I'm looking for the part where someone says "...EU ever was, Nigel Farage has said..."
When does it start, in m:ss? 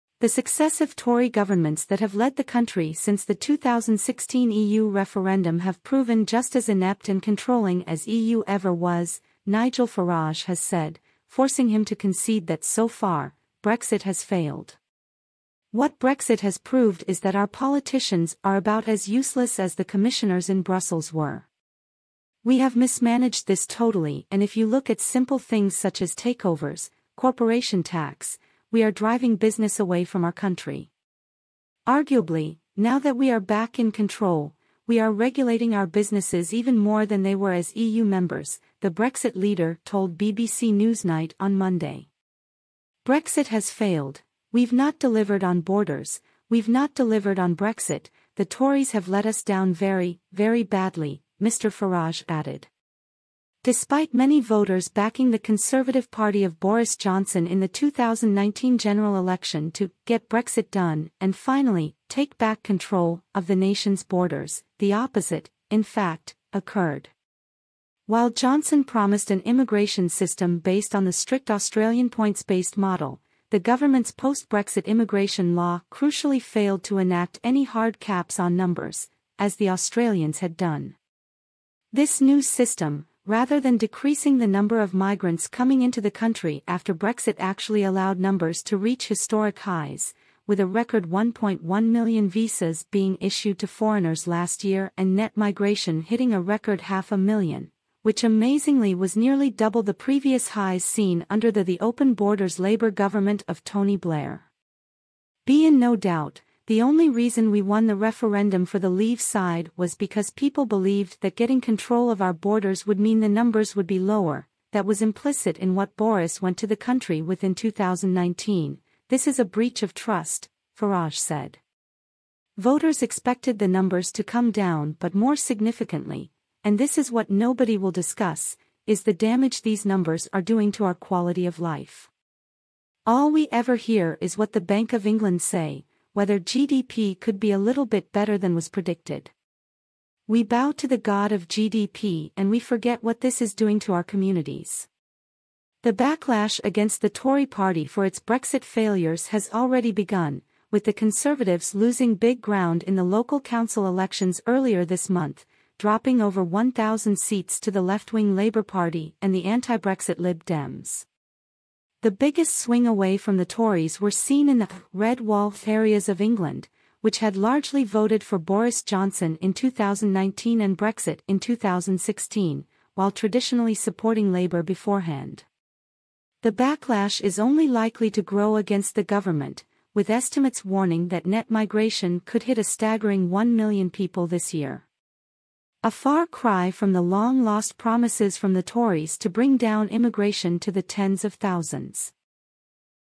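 0:08.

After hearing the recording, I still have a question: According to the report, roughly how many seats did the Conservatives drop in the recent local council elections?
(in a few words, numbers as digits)
over 1,000.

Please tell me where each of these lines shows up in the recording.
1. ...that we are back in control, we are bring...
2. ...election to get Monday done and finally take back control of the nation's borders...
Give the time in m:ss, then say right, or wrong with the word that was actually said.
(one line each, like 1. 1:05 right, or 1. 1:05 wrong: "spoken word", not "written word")
1. 0:32 wrong: "regulating", not "bring"
2. 0:59 wrong: "Brexit", not "Monday".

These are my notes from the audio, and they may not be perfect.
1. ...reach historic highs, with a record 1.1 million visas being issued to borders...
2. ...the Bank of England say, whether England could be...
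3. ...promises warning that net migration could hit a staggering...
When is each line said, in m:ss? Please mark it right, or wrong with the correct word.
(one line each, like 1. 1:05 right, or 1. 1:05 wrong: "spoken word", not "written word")
1. 1:28 wrong: "foreigners", not "borders"
2. 2:14 wrong: "GDP", not "England"
3. 3:00 wrong: "estimates", not "promises".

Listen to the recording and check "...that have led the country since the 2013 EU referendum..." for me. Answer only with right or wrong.
wrong.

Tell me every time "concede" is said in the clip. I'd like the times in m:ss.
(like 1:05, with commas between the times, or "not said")
0:11.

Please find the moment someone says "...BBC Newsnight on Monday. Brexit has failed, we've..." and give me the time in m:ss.
0:40.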